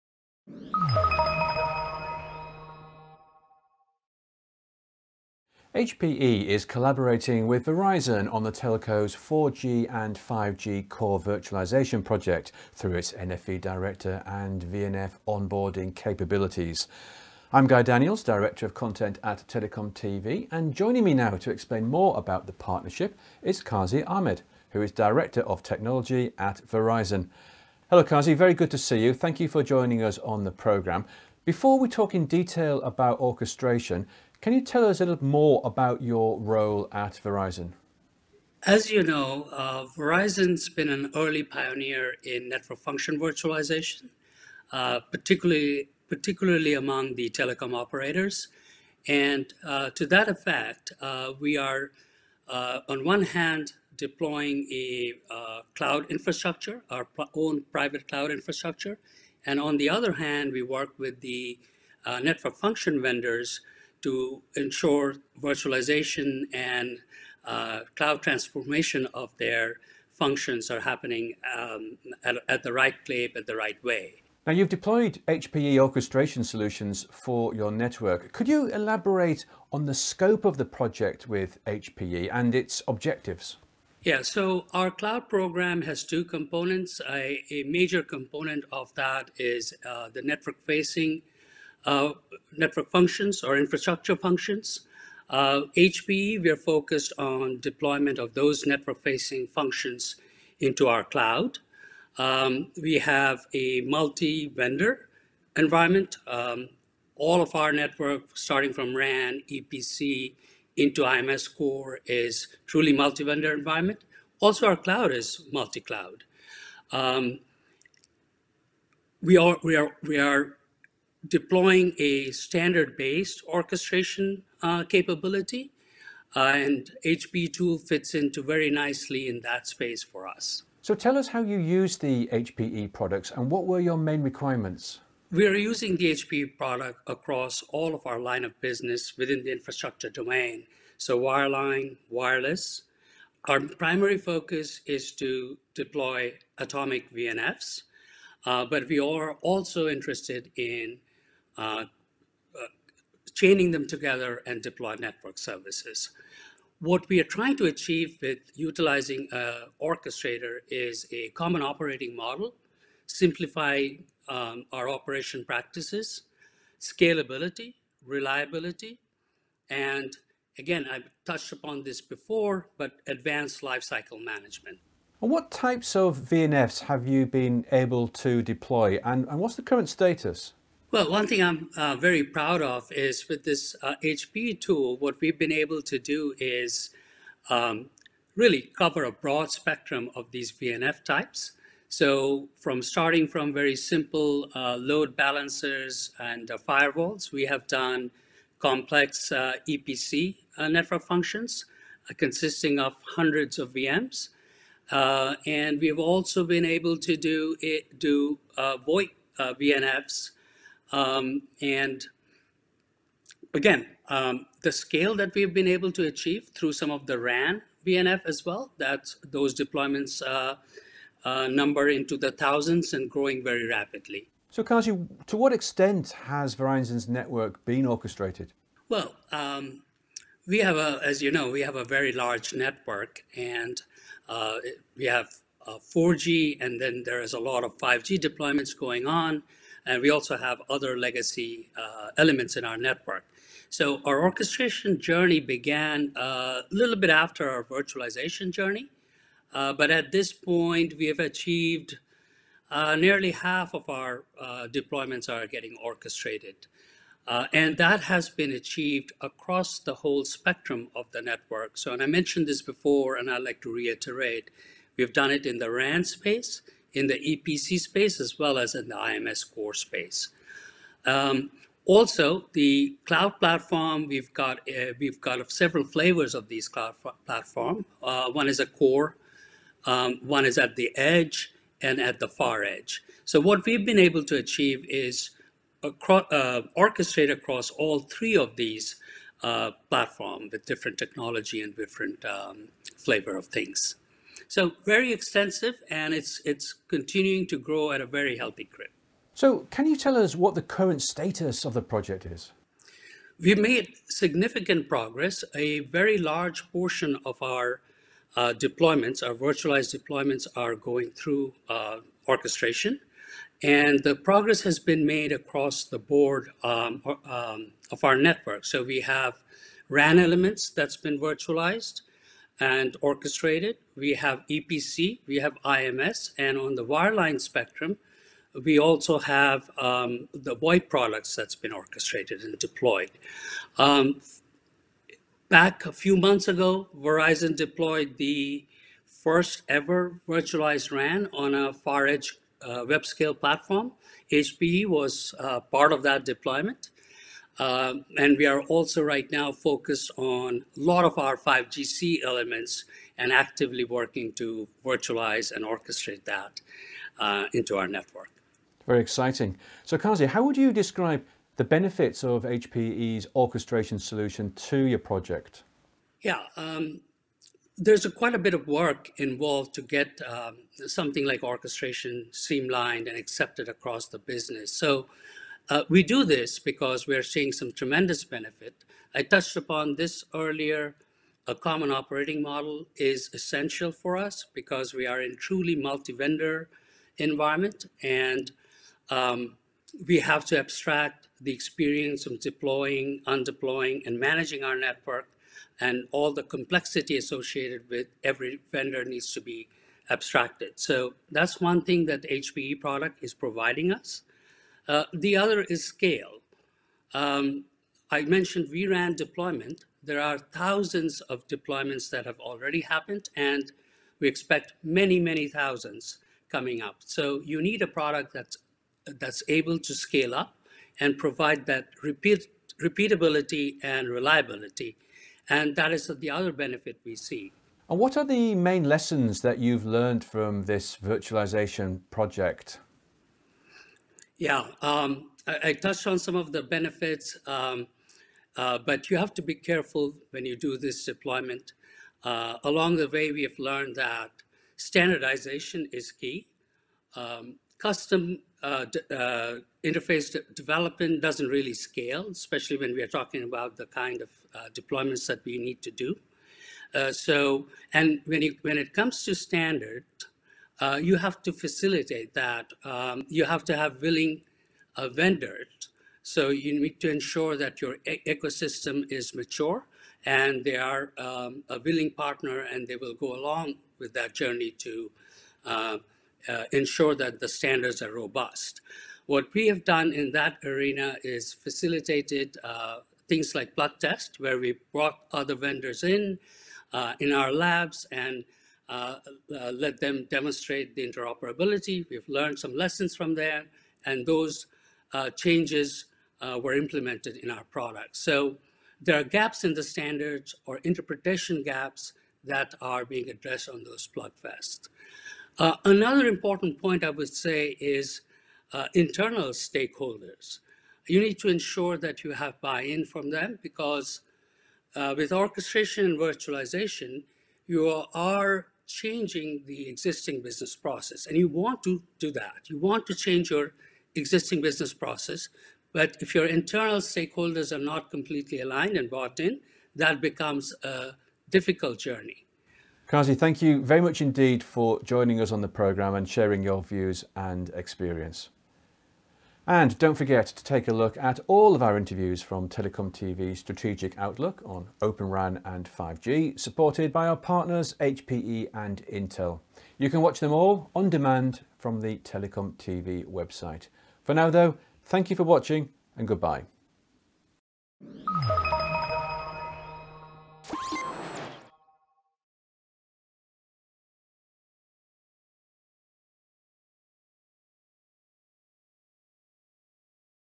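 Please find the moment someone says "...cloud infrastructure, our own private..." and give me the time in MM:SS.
00:55.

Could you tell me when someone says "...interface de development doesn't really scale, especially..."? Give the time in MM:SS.
07:29.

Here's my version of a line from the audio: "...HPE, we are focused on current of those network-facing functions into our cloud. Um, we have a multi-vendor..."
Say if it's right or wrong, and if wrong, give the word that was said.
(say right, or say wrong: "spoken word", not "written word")
wrong: "deployment", not "current".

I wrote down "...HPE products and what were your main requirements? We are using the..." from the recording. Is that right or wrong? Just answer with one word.
right.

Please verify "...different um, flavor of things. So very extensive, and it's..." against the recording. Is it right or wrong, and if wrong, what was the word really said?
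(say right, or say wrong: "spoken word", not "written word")
right.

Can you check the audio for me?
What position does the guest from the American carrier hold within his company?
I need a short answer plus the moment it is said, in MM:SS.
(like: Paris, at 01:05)
Director of Technology, at 00:24.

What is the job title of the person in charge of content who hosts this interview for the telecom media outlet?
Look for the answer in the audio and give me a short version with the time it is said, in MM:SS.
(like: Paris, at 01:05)
Director of Content, at 00:18.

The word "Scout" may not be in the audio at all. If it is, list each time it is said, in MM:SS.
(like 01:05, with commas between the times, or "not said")
not said.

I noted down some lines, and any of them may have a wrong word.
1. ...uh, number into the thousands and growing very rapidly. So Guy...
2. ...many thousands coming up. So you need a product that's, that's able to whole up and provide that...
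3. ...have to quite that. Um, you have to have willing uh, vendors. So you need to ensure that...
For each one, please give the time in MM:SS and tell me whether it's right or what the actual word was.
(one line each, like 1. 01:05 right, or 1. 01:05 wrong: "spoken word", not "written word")
1. 03:41 wrong: "Kazi", not "Guy"
2. 06:55 wrong: "scale", not "whole"
3. 07:41 wrong: "facilitate", not "quite".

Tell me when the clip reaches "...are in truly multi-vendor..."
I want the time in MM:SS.
06:25.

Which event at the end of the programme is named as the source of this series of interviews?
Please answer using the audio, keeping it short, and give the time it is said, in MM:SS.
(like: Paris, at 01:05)
Strategic Outlook on Open RAN and 5G, at 09:03.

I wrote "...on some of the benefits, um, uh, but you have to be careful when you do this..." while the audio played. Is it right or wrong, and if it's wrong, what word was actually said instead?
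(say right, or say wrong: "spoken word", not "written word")
right.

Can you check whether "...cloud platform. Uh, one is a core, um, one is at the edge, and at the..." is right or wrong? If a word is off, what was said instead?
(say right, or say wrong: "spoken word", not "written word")
right.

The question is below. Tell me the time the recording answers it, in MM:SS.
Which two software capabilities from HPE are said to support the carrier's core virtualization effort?
00:13.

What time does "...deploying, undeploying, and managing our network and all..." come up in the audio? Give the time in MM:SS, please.
06:32.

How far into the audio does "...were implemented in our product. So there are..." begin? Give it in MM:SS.
08:16.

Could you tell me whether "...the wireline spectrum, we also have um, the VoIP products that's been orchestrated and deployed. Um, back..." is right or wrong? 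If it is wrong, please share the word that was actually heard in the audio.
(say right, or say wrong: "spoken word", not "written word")
right.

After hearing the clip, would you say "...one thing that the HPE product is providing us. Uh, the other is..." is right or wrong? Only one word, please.
right.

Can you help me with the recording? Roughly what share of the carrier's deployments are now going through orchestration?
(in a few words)
nearly half.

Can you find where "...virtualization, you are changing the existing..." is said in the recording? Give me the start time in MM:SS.
08:36.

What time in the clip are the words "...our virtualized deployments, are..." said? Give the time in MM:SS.
05:09.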